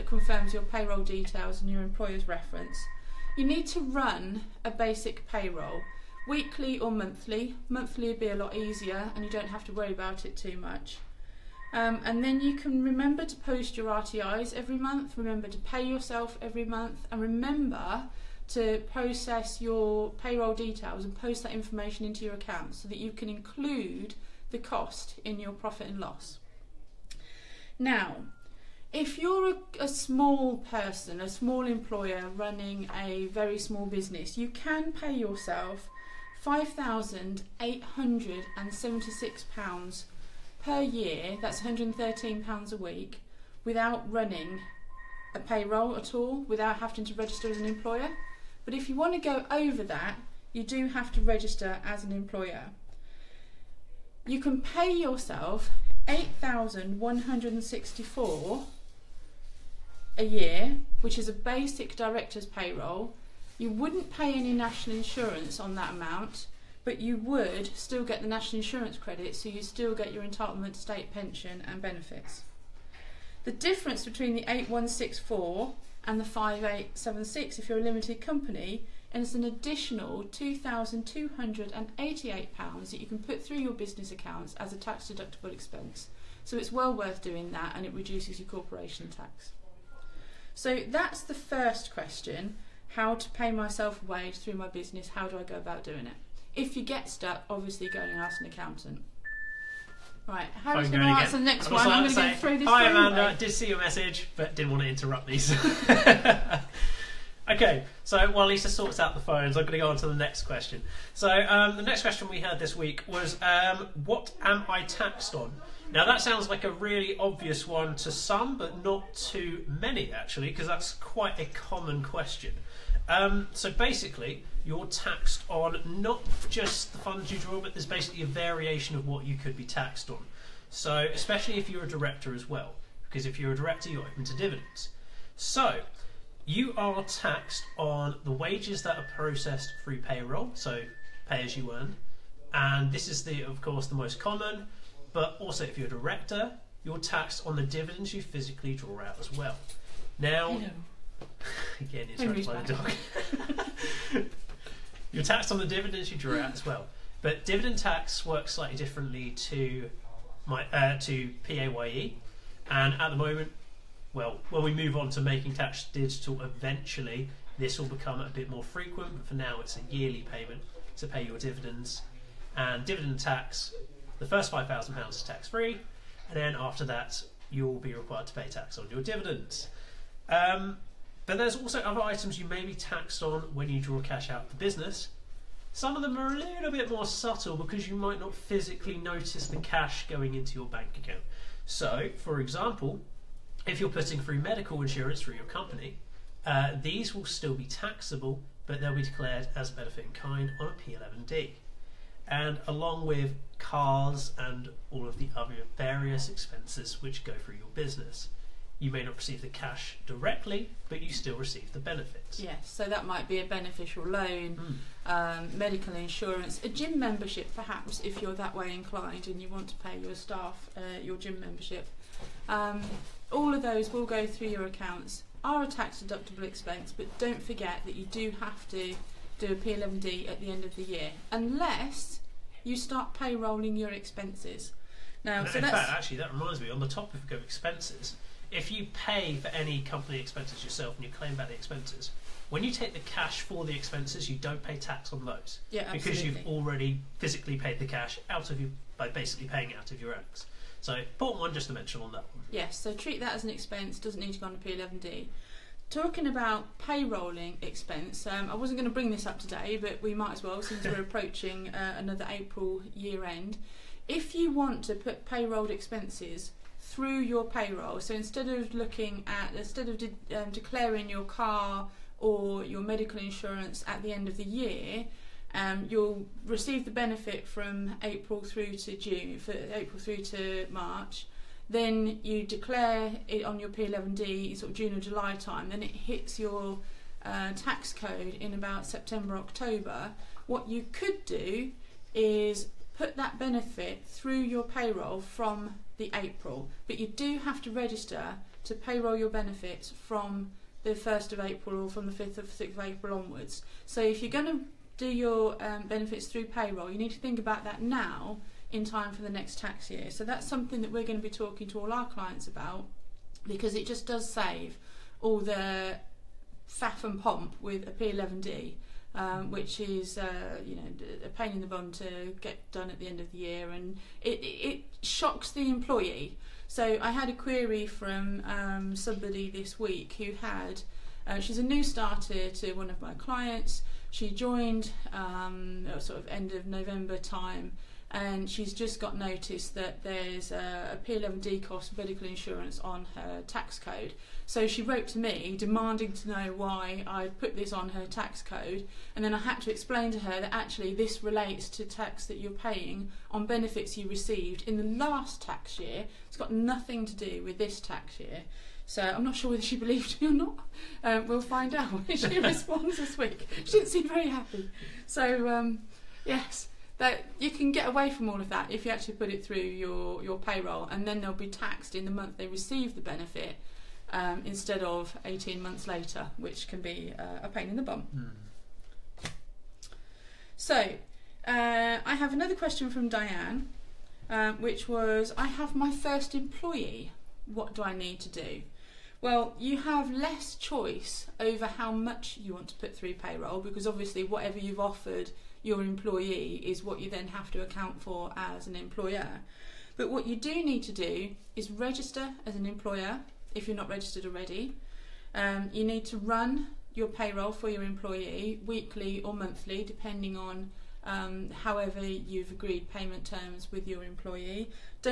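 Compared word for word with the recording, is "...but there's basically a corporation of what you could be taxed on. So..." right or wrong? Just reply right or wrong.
wrong.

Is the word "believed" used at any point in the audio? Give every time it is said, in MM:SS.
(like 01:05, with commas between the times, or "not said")
05:59.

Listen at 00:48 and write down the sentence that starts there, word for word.
But if you want to go over that, you do have to register as an employer.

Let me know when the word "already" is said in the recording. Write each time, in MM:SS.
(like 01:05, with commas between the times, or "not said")
04:06, 06:44.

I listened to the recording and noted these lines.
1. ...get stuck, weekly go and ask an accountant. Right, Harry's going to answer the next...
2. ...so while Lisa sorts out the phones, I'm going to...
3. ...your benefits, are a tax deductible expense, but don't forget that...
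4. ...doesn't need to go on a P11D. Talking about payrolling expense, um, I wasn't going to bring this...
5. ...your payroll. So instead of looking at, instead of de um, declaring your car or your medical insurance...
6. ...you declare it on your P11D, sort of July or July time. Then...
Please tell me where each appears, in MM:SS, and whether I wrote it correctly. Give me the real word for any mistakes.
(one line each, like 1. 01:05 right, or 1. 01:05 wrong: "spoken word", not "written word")
1. 01:36 wrong: "obviously", not "weekly"
2. 01:48 right
3. 03:44 wrong: "accounts", not "benefits"
4. 04:13 right
5. 04:27 right
6. 04:42 wrong: "June", not "July".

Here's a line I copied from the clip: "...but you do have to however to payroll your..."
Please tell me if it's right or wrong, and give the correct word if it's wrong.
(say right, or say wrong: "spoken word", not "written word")
wrong: "register", not "however".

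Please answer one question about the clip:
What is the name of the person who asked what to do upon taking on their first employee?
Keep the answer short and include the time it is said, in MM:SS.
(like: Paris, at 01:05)
Diane, at 06:23.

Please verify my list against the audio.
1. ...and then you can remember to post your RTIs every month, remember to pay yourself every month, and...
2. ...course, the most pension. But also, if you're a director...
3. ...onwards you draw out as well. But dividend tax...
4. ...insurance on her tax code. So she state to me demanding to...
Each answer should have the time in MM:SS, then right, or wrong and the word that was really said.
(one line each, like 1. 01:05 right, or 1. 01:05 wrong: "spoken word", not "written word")
1. 00:12 right
2. 02:23 wrong: "common", not "pension"
3. 02:35 wrong: "dividends", not "onwards"
4. 05:42 wrong: "wrote", not "state".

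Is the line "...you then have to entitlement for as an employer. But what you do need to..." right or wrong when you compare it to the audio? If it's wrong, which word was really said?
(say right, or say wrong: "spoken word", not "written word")
wrong: "account", not "entitlement".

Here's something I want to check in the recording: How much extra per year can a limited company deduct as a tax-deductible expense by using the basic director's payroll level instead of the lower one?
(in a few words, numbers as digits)
£2,288.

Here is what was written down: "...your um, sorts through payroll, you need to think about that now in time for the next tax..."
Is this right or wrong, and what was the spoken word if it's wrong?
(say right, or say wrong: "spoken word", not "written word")
wrong: "benefits", not "sorts".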